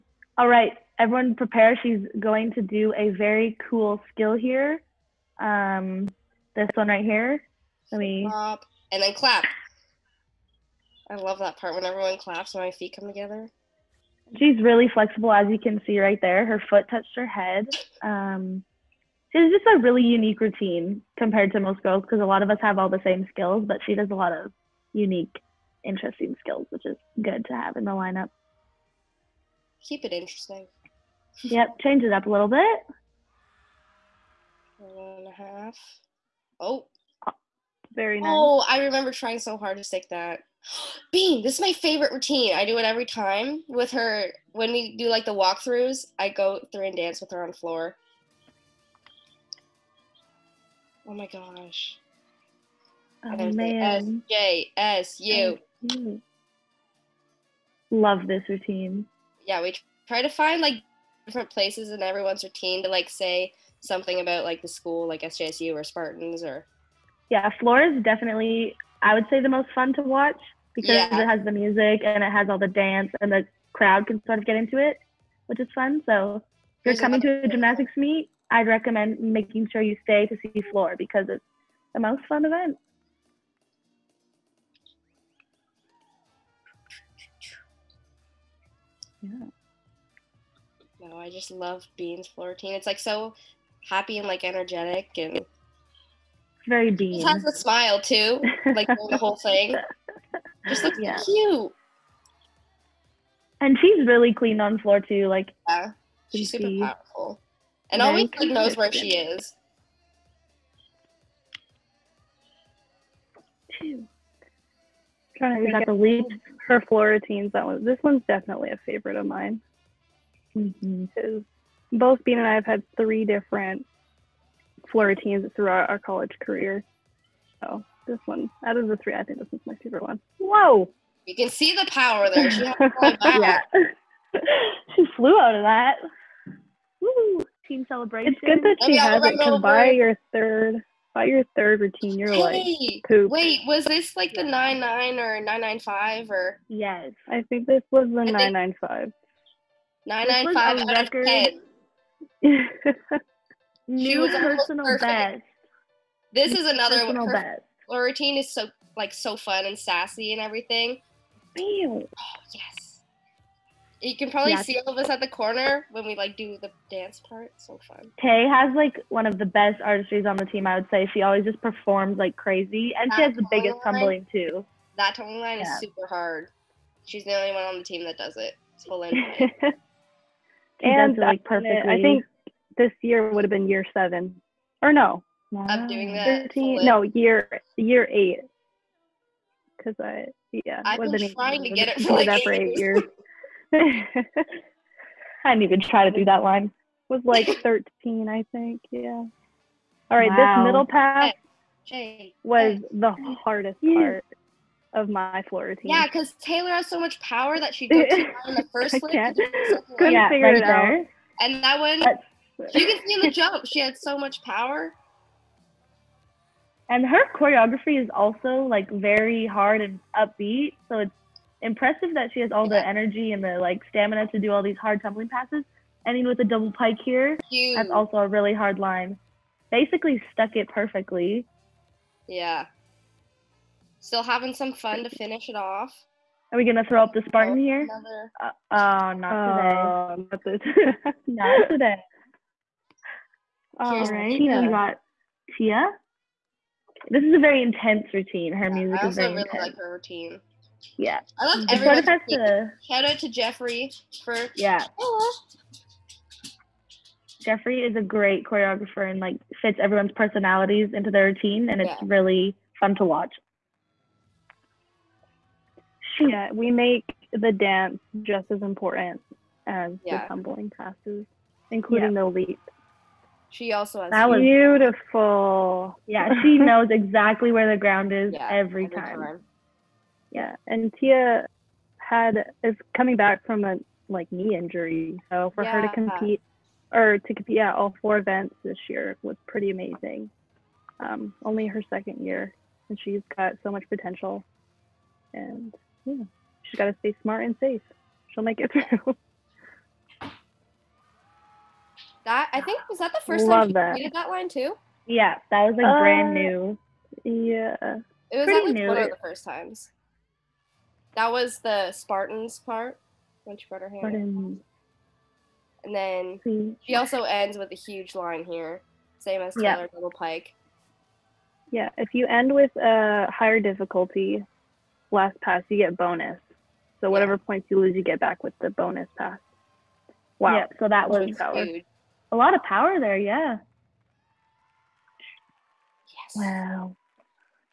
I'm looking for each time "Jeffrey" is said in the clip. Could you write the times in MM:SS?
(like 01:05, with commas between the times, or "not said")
04:13, 04:17.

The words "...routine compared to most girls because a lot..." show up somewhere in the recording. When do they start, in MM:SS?
00:20.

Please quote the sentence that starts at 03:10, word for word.
I've been trying to get it for, like eight years.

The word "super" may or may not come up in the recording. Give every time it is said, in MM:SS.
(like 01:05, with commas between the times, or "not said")
01:46, 02:55.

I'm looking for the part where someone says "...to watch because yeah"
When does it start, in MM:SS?
01:09.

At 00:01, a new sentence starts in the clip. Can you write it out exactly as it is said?
She's going to do a very cool skill here.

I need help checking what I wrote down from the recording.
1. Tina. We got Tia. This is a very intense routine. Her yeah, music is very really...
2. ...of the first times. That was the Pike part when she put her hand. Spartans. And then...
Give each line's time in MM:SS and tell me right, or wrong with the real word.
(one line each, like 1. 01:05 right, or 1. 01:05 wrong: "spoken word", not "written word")
1. 04:04 right
2. 05:08 wrong: "Spartans", not "Pike".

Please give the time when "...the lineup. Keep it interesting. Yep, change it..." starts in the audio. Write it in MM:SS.
00:27.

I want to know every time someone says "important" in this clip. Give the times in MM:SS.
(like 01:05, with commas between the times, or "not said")
04:28.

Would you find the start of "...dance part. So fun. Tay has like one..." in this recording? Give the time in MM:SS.
02:46.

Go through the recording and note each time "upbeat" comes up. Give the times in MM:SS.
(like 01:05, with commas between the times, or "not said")
03:40.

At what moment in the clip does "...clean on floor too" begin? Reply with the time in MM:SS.
01:44.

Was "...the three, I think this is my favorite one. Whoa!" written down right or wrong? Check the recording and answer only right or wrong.
right.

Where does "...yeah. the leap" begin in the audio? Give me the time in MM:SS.
04:32.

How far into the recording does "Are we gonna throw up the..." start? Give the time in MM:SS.
03:56.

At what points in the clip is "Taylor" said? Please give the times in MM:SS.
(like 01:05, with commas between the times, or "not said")
03:26, 05:19.